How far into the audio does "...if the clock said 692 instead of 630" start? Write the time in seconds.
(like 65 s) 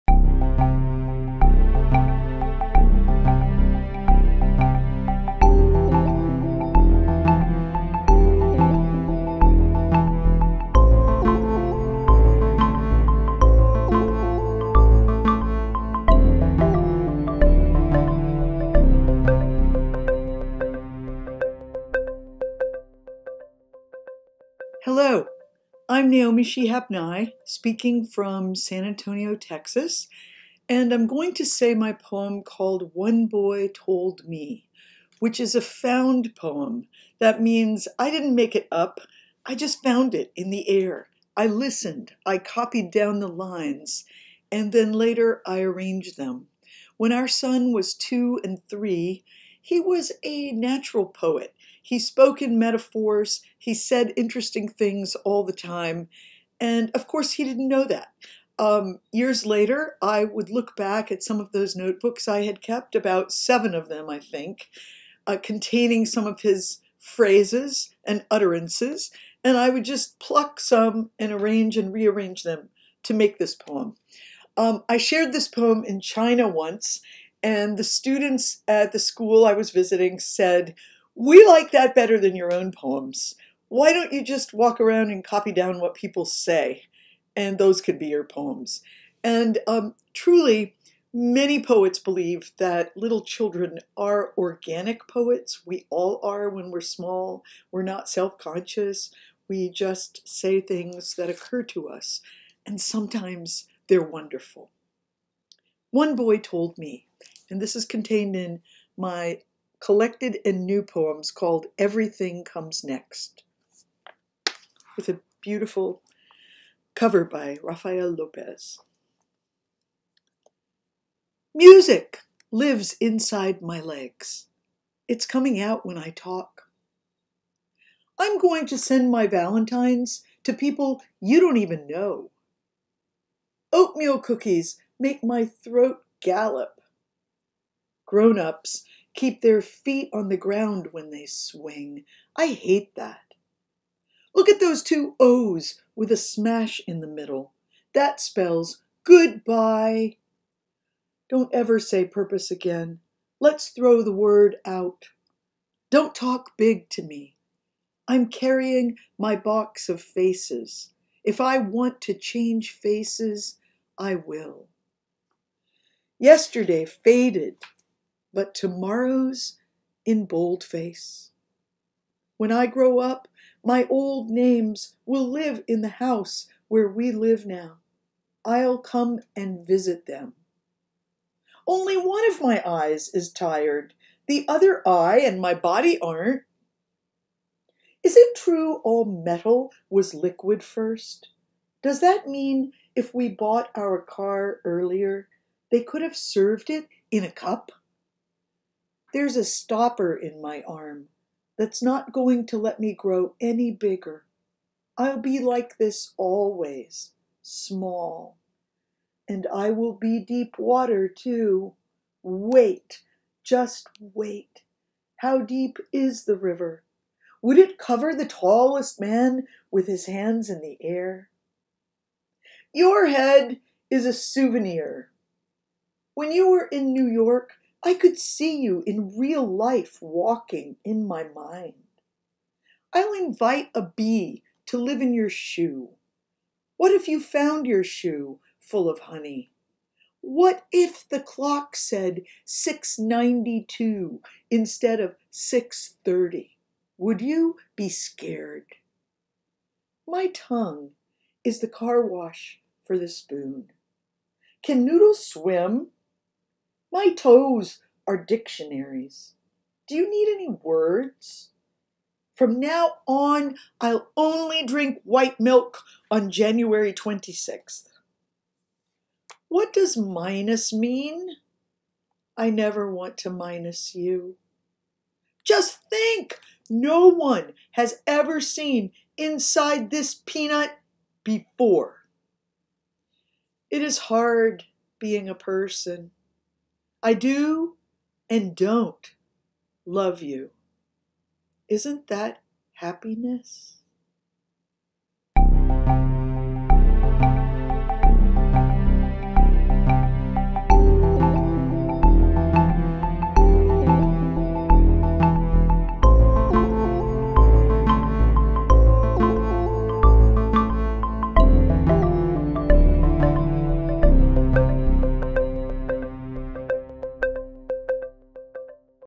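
240 s.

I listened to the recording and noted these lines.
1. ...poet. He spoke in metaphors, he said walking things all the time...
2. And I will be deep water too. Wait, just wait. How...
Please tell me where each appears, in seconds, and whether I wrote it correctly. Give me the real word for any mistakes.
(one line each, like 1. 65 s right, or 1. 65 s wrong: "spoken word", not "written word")
1. 51 s wrong: "interesting", not "walking"
2. 209 s right.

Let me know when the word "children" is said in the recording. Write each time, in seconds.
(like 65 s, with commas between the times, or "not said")
93 s.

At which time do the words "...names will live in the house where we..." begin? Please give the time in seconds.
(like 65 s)
174 s.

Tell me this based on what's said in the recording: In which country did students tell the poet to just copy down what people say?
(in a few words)
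China.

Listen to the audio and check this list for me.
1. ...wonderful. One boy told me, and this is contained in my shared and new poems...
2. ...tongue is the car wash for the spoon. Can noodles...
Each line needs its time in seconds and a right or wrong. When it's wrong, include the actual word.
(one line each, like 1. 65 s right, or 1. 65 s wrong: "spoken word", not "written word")
1. 104 s wrong: "collected", not "shared"
2. 250 s right.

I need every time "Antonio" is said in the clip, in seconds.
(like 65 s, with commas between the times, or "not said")
28 s.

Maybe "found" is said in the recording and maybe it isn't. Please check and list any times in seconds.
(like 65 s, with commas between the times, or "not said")
35 s, 39 s, 237 s.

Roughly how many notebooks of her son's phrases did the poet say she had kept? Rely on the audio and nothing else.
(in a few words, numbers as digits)
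7.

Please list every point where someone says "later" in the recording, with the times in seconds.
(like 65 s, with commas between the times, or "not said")
44 s, 59 s.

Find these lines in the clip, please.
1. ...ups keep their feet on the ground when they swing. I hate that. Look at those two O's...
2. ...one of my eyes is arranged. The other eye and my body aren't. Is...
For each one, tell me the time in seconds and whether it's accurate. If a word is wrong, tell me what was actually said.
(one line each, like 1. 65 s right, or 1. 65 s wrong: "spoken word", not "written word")
1. 138 s right
2. 181 s wrong: "tired", not "arranged".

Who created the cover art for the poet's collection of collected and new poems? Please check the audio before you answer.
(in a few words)
Rafael Lopez.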